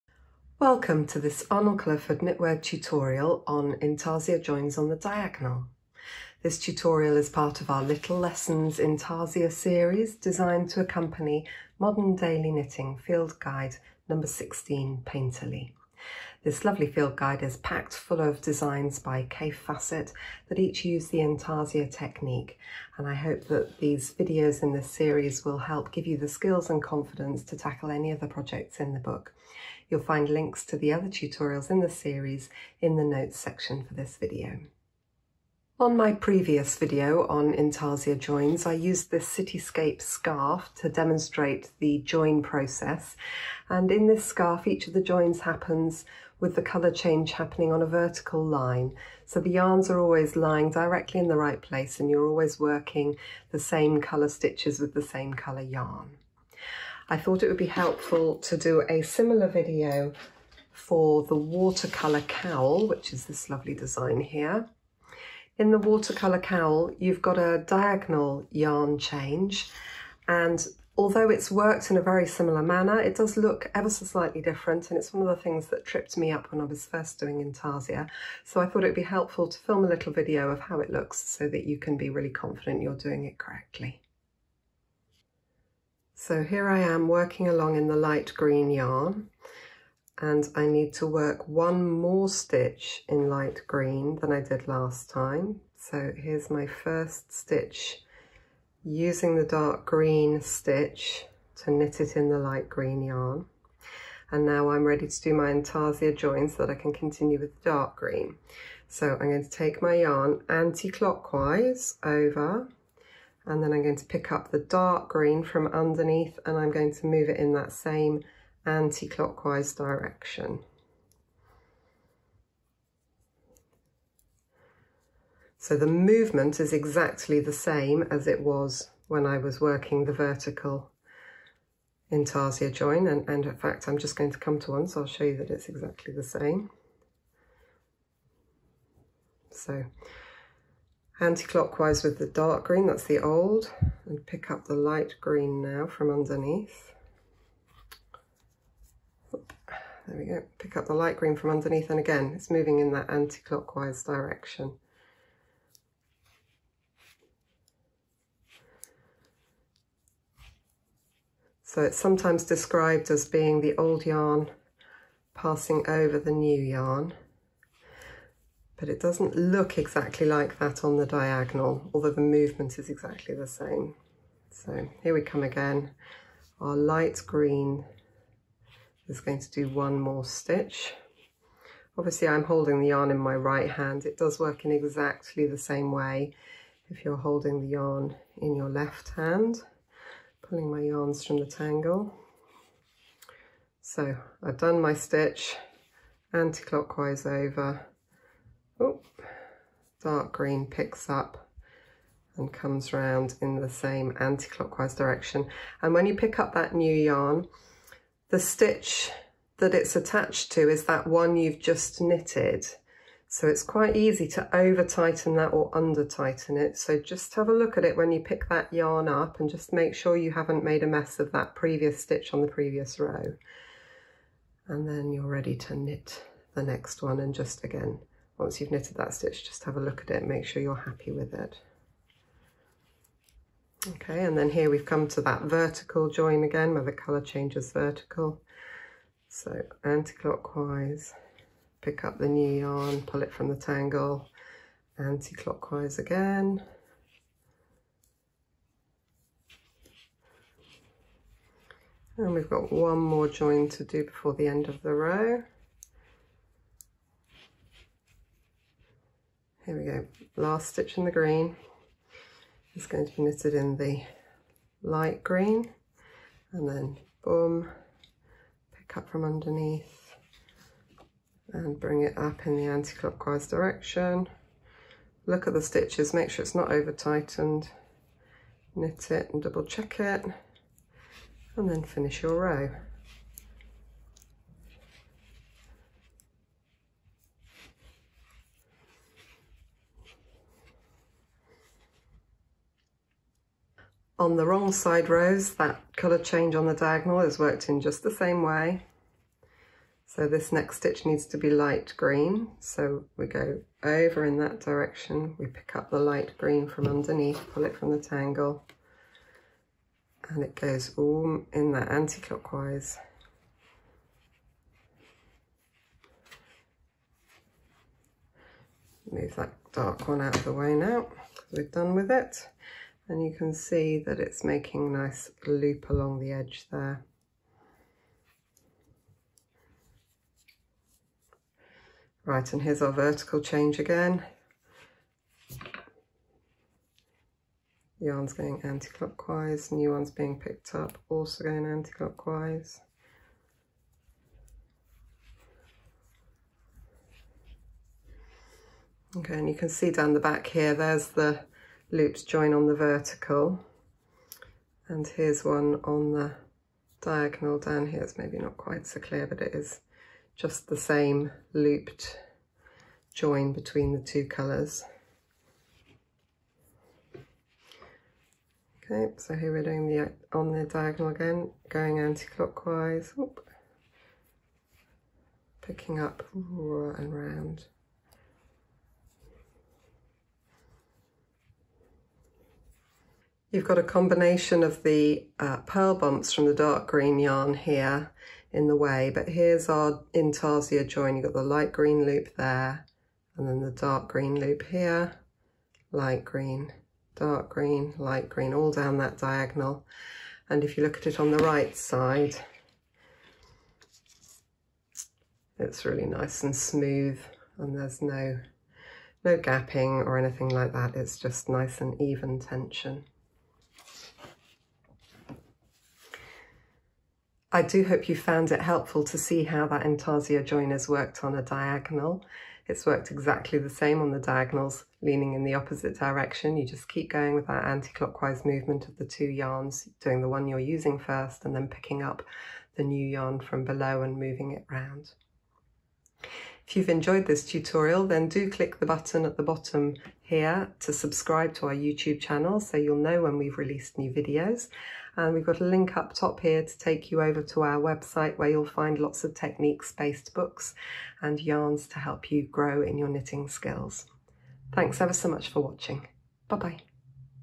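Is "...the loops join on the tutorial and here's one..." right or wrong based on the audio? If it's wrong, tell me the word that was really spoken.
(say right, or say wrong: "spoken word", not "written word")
wrong: "vertical", not "tutorial".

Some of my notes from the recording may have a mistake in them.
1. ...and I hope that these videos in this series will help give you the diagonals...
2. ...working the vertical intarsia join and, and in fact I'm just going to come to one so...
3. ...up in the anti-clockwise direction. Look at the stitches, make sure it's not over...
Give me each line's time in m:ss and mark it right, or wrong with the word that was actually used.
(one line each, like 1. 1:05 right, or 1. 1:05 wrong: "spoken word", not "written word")
1. 0:22 wrong: "skills", not "diagonals"
2. 2:09 right
3. 4:32 right.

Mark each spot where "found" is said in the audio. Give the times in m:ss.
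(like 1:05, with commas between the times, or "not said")
6:58.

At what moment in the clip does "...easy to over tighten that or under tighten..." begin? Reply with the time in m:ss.
3:33.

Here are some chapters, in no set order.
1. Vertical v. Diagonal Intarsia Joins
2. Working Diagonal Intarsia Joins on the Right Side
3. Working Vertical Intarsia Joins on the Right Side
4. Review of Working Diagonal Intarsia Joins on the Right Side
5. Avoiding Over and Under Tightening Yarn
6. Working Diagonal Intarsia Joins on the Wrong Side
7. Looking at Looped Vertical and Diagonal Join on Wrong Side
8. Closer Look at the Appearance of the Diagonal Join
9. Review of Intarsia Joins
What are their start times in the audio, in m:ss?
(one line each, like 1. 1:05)
1. 0:36
2. 1:25
3. 2:18
4. 2:57
5. 3:24
6. 4:54
7. 5:48
8. 6:23
9. 6:57.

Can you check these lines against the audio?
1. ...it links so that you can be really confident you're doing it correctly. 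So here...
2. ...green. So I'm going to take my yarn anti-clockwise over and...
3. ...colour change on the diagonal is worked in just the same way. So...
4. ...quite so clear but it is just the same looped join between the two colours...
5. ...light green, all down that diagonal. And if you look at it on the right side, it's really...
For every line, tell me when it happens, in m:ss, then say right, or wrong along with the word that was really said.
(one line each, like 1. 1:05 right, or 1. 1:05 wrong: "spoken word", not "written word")
1. 1:20 wrong: "looks", not "links"
2. 1:47 right
3. 4:55 right
4. 5:58 right
5. 6:37 right.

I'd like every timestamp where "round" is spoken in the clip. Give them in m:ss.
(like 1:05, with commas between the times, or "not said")
3:22, 6:17, 7:14.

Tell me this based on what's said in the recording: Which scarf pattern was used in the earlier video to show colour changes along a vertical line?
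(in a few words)
Cityscape scarf.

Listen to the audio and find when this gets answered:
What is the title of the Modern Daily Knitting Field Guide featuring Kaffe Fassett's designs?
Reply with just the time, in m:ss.
0:15.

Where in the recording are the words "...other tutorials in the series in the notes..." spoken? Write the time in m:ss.
0:30.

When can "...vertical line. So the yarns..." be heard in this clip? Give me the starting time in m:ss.
0:47.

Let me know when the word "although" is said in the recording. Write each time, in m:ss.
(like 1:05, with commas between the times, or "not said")
1:10, 2:51.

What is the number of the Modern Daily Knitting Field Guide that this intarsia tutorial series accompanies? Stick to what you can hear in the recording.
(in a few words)
16.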